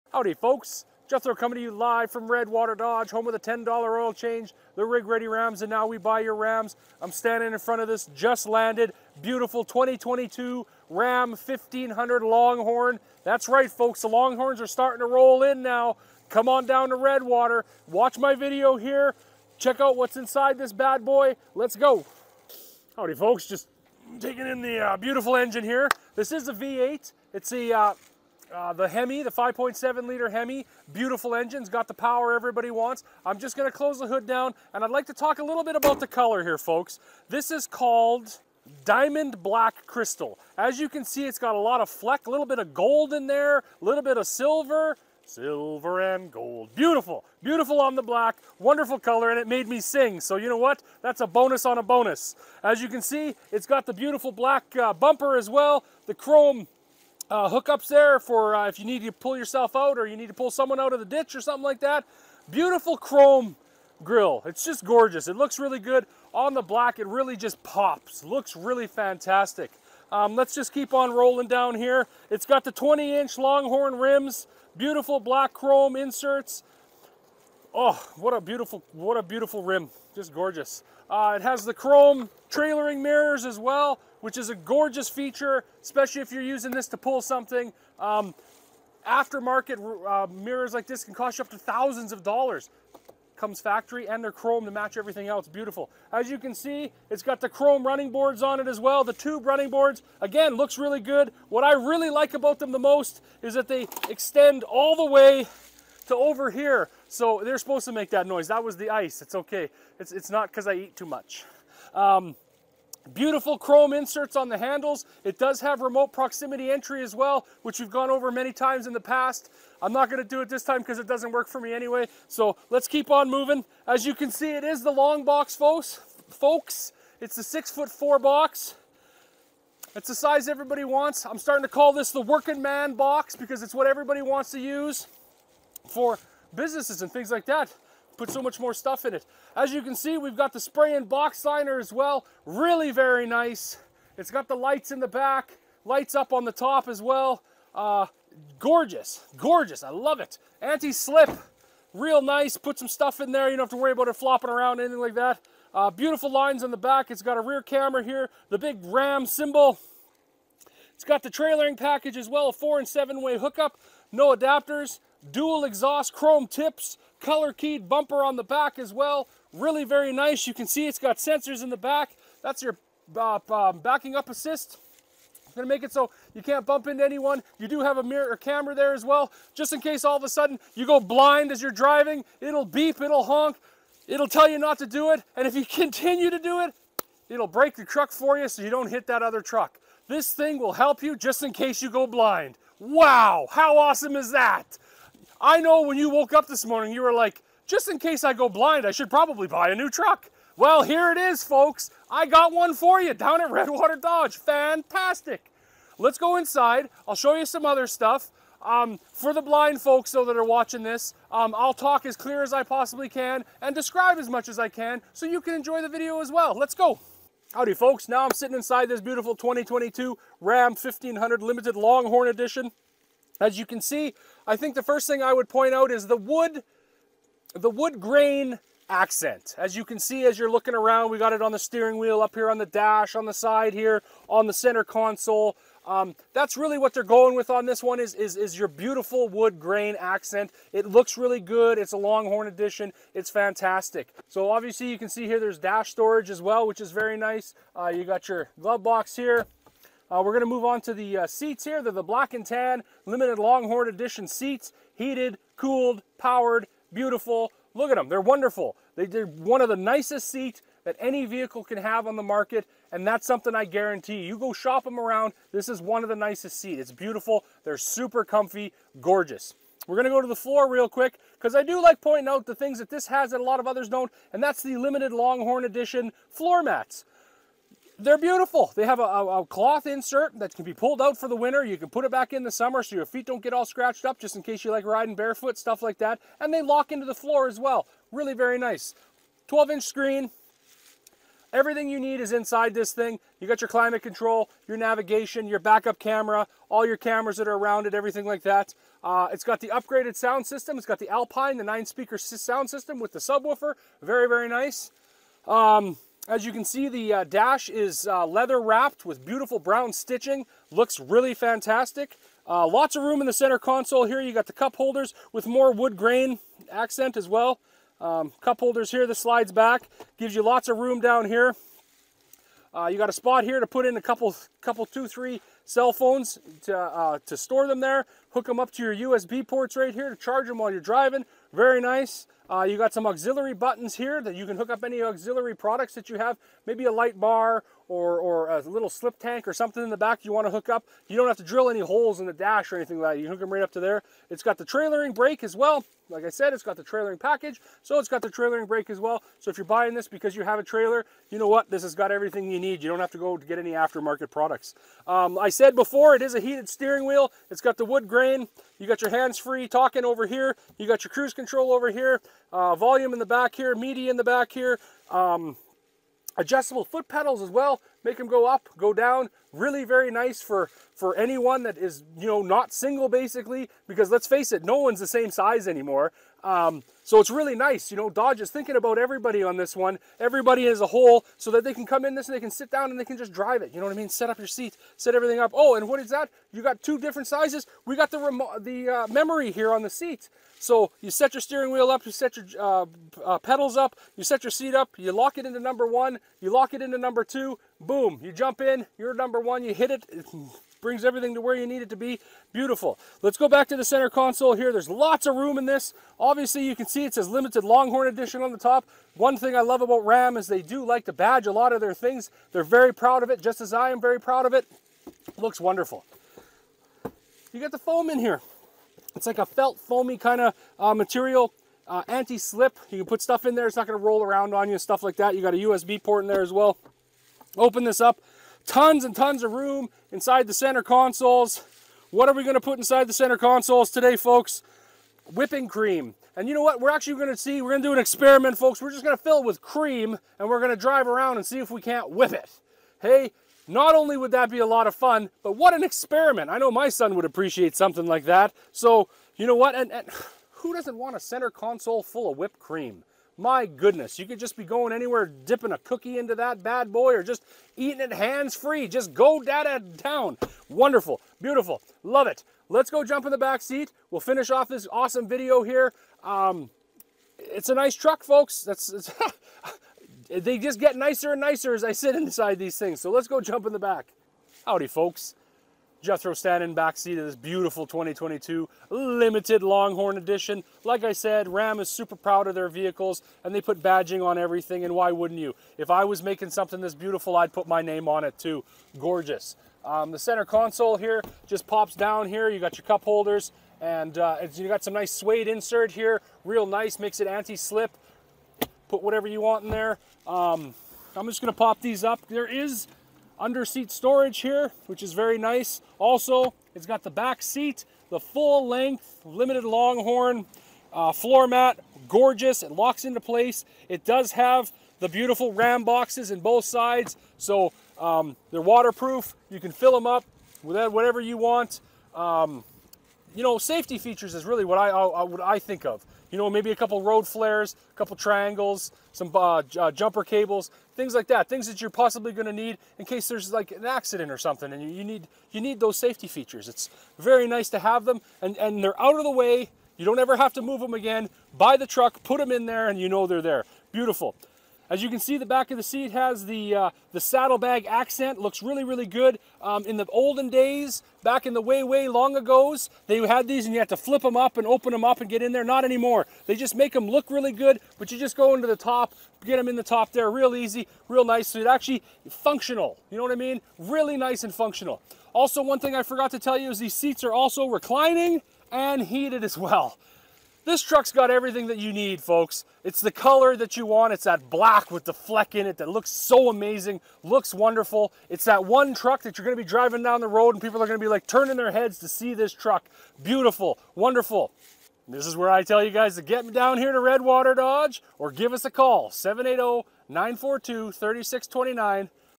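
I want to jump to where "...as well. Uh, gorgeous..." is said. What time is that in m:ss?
2:26.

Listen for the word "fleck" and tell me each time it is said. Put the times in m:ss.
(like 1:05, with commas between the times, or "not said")
0:41, 9:35.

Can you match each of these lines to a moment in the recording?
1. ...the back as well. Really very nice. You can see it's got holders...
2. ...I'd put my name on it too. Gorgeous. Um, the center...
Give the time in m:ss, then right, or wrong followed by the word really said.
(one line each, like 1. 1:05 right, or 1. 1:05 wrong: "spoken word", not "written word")
1. 2:48 wrong: "sensors", not "holders"
2. 8:07 right.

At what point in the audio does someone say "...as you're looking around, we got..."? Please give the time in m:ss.
3:50.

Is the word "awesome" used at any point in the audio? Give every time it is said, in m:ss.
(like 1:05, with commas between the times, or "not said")
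3:13, 7:44.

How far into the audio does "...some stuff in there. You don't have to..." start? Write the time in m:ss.
2:32.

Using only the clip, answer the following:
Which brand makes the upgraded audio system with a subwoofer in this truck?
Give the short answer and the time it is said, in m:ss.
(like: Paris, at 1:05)
Alpine, at 5:01.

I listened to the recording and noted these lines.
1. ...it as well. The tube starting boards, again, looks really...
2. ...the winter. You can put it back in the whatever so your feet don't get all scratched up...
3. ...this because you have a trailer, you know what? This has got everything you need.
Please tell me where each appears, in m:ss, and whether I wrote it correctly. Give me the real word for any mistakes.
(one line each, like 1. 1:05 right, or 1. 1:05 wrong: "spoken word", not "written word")
1. 1:38 wrong: "running", not "starting"
2. 4:41 wrong: "summer", not "whatever"
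3. 5:49 right.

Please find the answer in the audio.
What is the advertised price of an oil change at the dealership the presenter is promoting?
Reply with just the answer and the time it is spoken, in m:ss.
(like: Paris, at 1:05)
$10, at 0:03.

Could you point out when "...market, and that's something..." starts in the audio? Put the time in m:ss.
4:22.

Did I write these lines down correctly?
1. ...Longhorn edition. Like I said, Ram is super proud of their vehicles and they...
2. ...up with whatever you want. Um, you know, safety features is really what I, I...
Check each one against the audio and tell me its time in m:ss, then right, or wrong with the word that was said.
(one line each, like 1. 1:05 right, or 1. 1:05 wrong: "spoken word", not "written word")
1. 7:59 right
2. 8:40 right.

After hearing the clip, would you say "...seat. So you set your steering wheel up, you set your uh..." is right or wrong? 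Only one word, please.
right.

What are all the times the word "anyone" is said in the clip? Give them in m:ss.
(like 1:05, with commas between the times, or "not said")
2:57, 6:11.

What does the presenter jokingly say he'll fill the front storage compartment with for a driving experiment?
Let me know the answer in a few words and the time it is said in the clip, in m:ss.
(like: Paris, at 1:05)
Whipping cream, at 7:15.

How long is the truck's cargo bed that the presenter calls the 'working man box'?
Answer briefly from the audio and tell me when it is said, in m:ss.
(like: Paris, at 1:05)
6 foot 4, at 2:07.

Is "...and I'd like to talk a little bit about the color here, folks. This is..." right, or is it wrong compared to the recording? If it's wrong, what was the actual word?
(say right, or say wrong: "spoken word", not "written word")
right.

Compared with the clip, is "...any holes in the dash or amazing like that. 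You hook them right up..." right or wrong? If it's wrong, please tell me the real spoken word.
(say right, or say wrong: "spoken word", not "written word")
wrong: "anything", not "amazing".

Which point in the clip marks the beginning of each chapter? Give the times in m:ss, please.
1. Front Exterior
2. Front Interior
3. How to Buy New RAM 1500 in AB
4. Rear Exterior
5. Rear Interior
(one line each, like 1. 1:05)
1. 0:22
2. 3:37
3. 9:44
4. 2:03
5. 7:54.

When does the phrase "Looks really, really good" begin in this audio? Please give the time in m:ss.
9:08.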